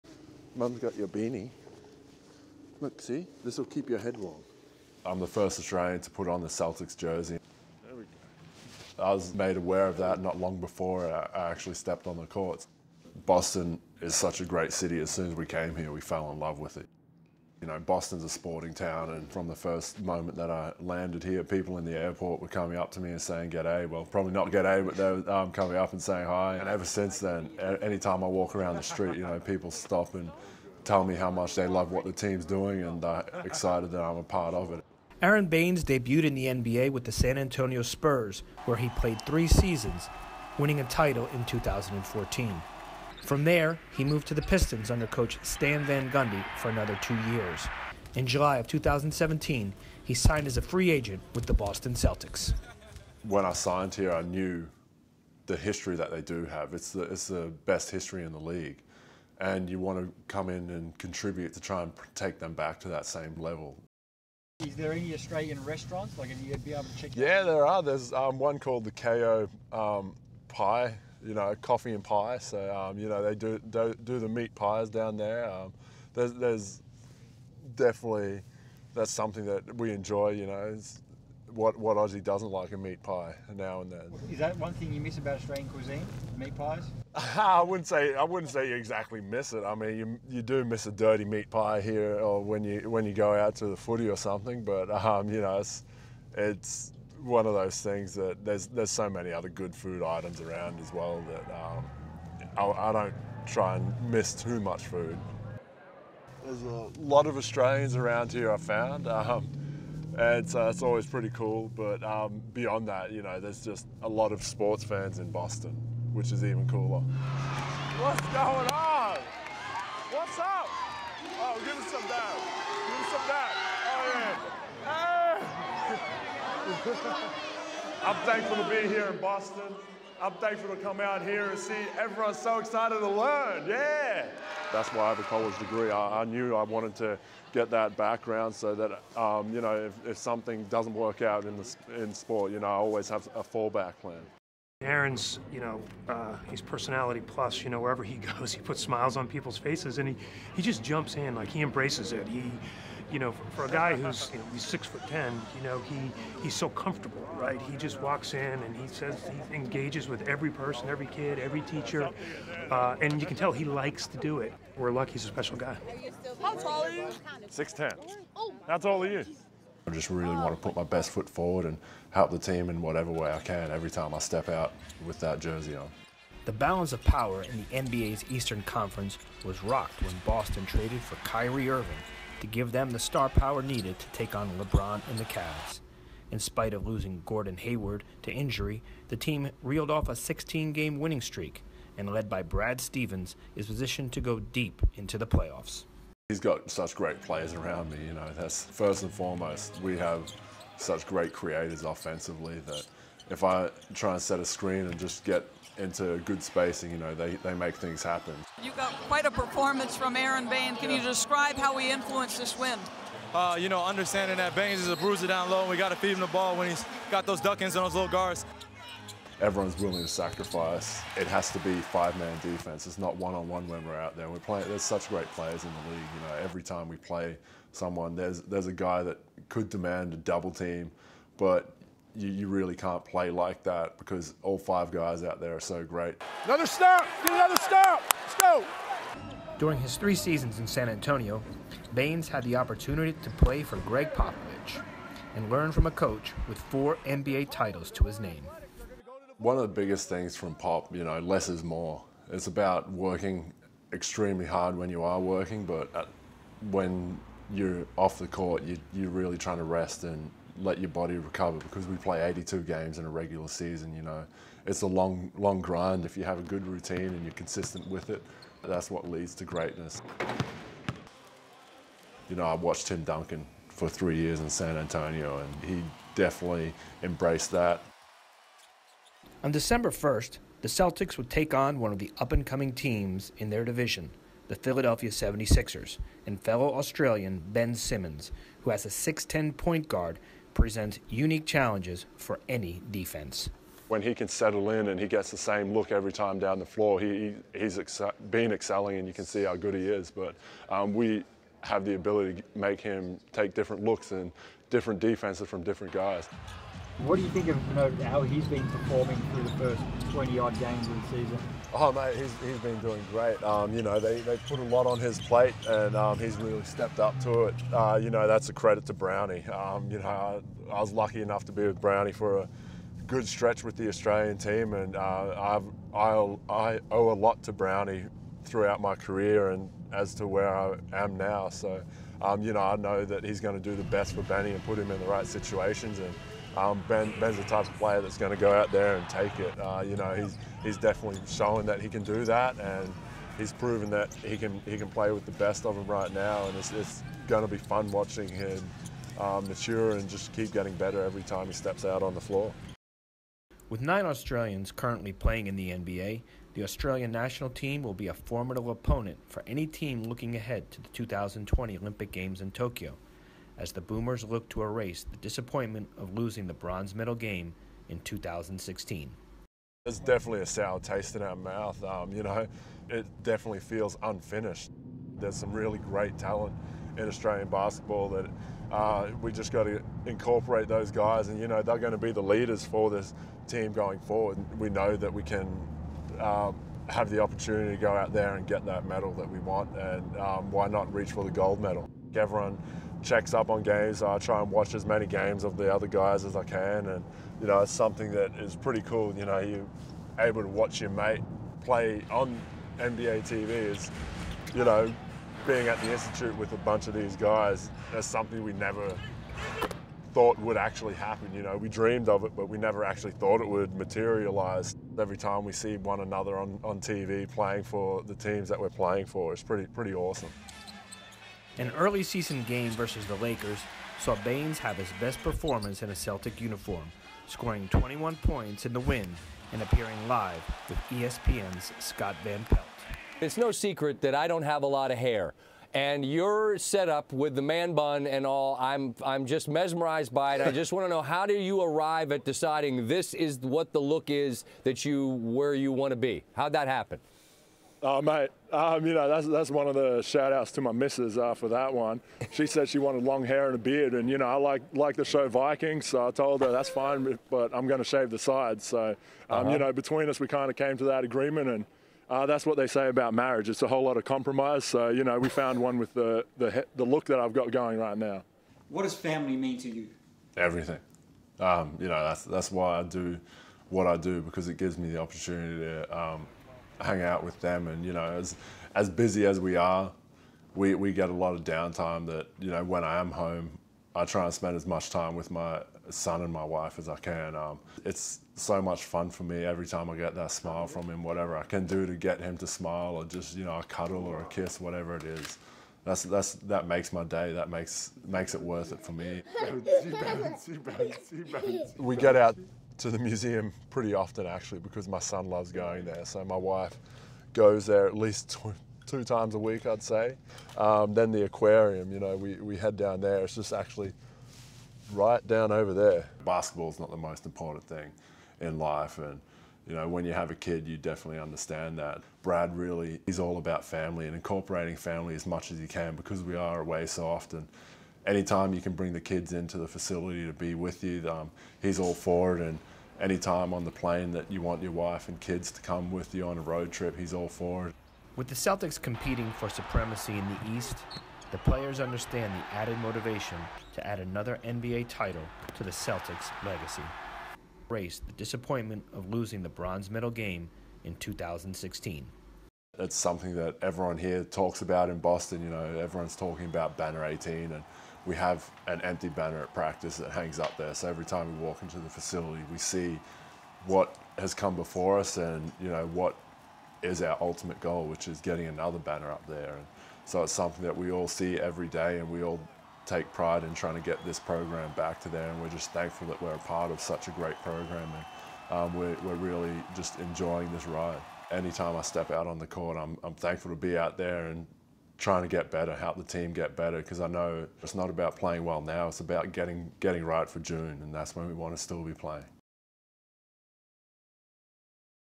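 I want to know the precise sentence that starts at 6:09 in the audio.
There's definitely a sour taste in our mouth.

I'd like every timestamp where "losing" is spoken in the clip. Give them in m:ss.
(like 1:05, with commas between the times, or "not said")
3:06, 6:06, 9:09.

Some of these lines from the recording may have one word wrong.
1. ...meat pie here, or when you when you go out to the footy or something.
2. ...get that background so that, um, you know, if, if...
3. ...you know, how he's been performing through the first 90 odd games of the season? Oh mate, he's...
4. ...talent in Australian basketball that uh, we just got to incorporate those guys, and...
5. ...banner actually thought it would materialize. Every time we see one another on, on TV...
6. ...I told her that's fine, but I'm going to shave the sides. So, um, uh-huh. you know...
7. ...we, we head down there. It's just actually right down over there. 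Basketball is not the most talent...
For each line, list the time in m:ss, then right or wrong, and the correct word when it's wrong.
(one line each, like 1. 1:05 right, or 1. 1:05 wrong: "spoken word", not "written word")
1. 1:31 right
2. 2:17 right
3. 5:07 wrong: "20", not "90"
4. 6:16 right
5. 6:52 wrong: "never", not "banner"
6. 7:36 right
7. 8:32 wrong: "important", not "talent".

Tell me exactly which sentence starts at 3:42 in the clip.
It's not one-on-one -on -one when we're out there.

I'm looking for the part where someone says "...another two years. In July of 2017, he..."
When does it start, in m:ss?
0:46.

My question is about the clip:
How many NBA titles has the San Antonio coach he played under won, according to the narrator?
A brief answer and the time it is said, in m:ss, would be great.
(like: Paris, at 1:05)
4, at 4:06.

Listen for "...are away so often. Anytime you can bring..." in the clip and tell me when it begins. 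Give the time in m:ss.
8:46.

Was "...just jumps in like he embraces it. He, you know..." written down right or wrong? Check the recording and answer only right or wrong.
right.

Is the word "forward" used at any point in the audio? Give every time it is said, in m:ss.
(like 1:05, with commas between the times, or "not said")
2:51, 6:23.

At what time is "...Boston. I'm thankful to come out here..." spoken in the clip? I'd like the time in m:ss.
2:09.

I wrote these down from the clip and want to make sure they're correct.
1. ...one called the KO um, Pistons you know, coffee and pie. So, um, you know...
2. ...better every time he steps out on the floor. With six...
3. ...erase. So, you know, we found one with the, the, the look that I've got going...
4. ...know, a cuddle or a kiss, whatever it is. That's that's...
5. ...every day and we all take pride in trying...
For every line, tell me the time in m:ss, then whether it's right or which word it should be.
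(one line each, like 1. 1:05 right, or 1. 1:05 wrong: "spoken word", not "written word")
1. 1:08 wrong: "Pie", not "Pistons"
2. 5:50 wrong: "nine", not "six"
3. 7:44 wrong: "compromise", not "erase"
4. 8:13 right
5. 9:31 right.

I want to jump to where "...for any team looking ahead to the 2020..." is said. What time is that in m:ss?
5:59.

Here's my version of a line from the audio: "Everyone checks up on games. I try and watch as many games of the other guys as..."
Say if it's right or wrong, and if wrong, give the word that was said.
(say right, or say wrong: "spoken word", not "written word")
right.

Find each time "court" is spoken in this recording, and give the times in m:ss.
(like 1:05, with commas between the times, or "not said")
0:12, 4:18, 9:42.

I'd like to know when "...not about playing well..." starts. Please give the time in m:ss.
9:47.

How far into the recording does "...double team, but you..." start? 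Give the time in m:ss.
3:50.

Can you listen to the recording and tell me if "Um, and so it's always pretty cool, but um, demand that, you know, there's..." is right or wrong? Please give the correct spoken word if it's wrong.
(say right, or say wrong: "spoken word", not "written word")
wrong: "beyond", not "demand".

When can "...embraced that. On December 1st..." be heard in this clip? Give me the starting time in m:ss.
4:37.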